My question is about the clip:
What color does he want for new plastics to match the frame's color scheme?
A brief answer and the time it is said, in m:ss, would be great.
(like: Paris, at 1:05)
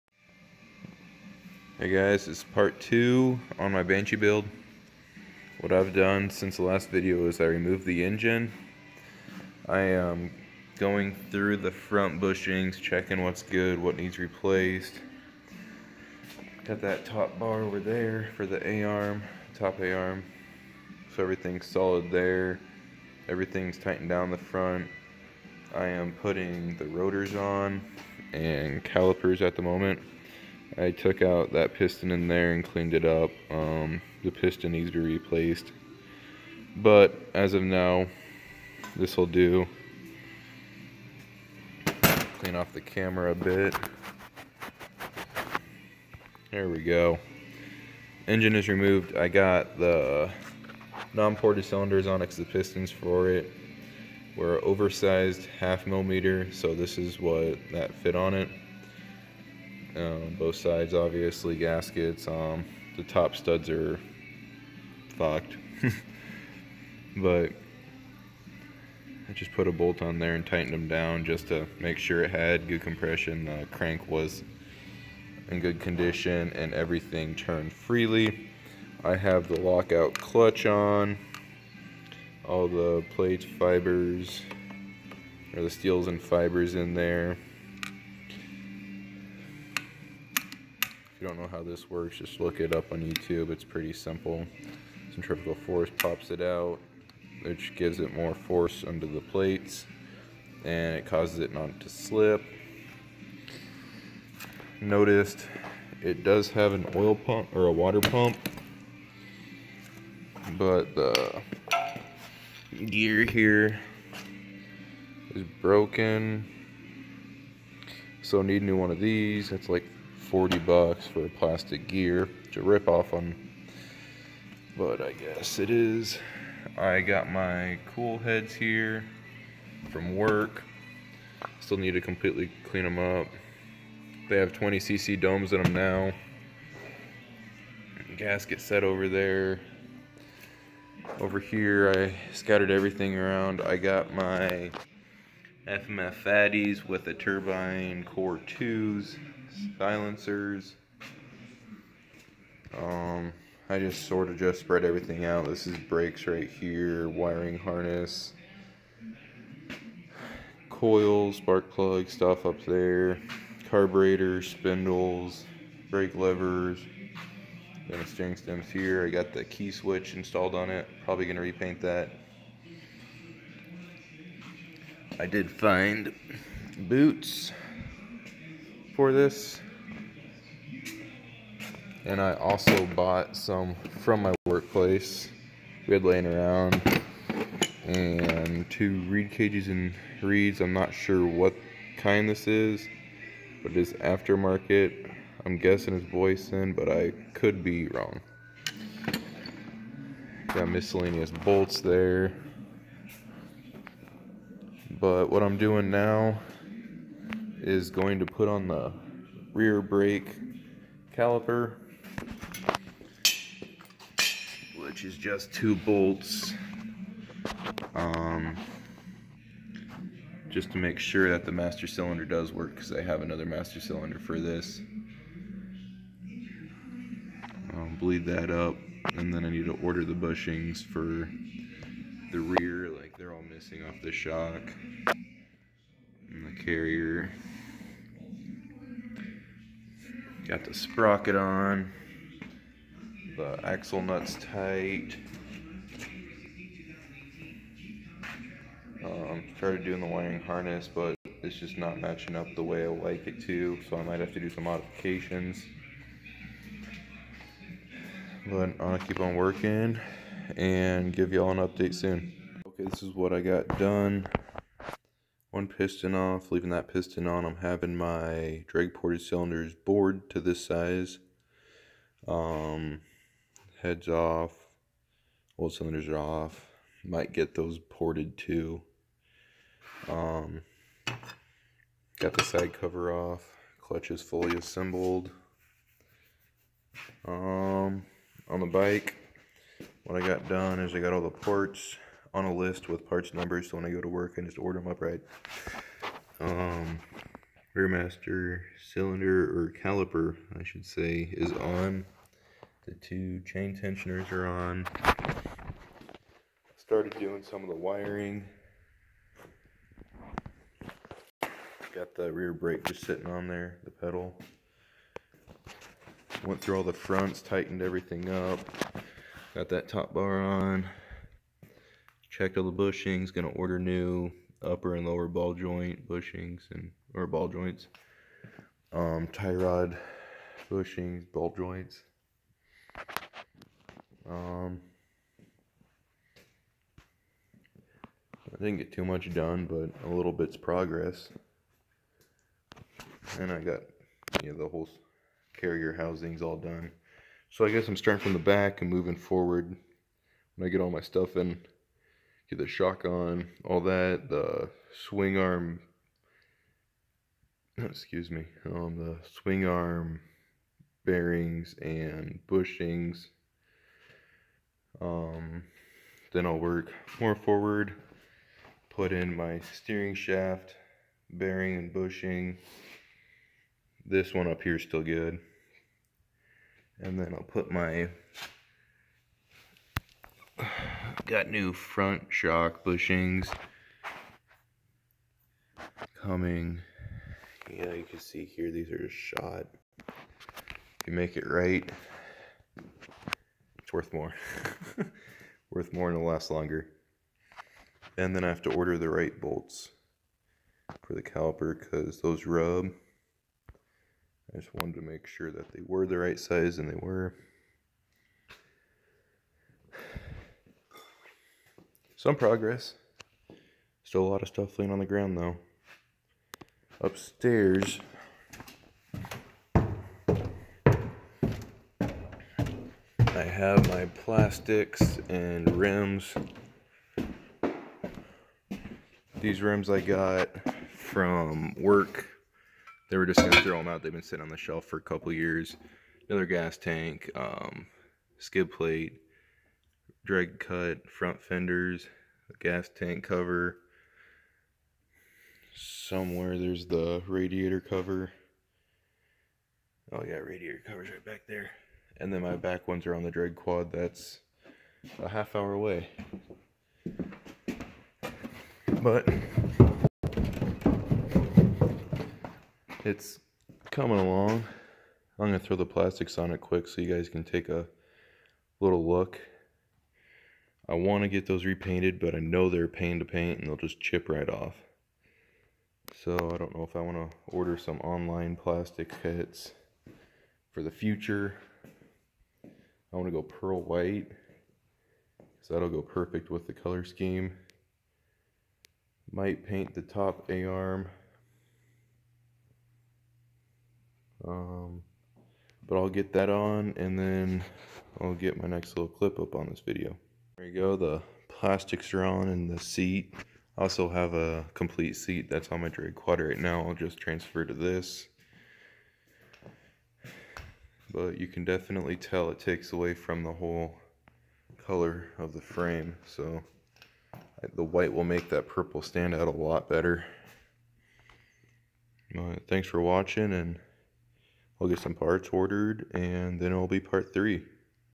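pearl white, at 8:03.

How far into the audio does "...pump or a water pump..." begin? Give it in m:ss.
1:47.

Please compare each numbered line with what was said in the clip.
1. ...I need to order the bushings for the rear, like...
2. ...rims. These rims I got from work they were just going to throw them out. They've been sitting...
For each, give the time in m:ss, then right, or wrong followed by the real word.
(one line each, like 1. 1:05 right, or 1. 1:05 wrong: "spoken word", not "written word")
1. 3:49 right
2. 7:05 right.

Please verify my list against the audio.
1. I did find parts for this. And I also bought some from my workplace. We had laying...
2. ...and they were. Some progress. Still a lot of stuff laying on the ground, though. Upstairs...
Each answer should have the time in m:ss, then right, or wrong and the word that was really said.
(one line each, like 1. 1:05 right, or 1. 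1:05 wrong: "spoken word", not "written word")
1. 2:55 wrong: "boots", not "parts"
2. 6:46 right.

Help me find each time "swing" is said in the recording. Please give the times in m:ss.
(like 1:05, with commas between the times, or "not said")
5:55, 5:59.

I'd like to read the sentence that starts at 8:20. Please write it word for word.
There you go, the plastics are on and the seat.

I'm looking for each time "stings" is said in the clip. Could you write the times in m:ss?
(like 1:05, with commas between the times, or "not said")
not said.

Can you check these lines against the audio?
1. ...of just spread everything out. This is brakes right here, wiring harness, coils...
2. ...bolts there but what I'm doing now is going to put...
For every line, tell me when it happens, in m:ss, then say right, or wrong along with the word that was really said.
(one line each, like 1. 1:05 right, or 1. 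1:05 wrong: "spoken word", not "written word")
1. 2:34 right
2. 3:21 right.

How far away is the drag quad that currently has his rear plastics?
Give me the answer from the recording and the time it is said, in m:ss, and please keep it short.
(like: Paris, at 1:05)
half hour, at 7:35.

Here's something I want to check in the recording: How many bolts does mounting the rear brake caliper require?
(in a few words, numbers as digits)
2.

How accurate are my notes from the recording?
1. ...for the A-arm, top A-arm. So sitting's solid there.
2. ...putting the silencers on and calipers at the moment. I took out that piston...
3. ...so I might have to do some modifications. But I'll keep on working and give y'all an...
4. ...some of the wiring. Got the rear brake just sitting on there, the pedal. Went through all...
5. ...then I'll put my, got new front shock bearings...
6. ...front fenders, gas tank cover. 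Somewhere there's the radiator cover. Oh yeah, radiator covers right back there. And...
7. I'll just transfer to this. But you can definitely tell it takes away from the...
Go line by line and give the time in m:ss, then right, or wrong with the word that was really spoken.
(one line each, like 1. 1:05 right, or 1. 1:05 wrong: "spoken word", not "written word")
1. 0:18 wrong: "everything", not "sitting"
2. 0:26 wrong: "rotors", not "silencers"
3. 4:13 right
4. 5:07 right
5. 6:17 wrong: "bushings", not "bearings"
6. 7:21 right
7. 8:26 right.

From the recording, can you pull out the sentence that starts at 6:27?
Yeah, you can see here, these are just shot.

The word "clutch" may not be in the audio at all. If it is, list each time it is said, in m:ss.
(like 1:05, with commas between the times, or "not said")
1:20, 4:43.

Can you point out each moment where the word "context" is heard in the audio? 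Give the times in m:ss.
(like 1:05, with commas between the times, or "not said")
not said.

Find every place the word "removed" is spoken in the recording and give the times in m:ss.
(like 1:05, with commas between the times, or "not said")
0:07, 0:48.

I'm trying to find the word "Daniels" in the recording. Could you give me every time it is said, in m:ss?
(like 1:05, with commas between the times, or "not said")
not said.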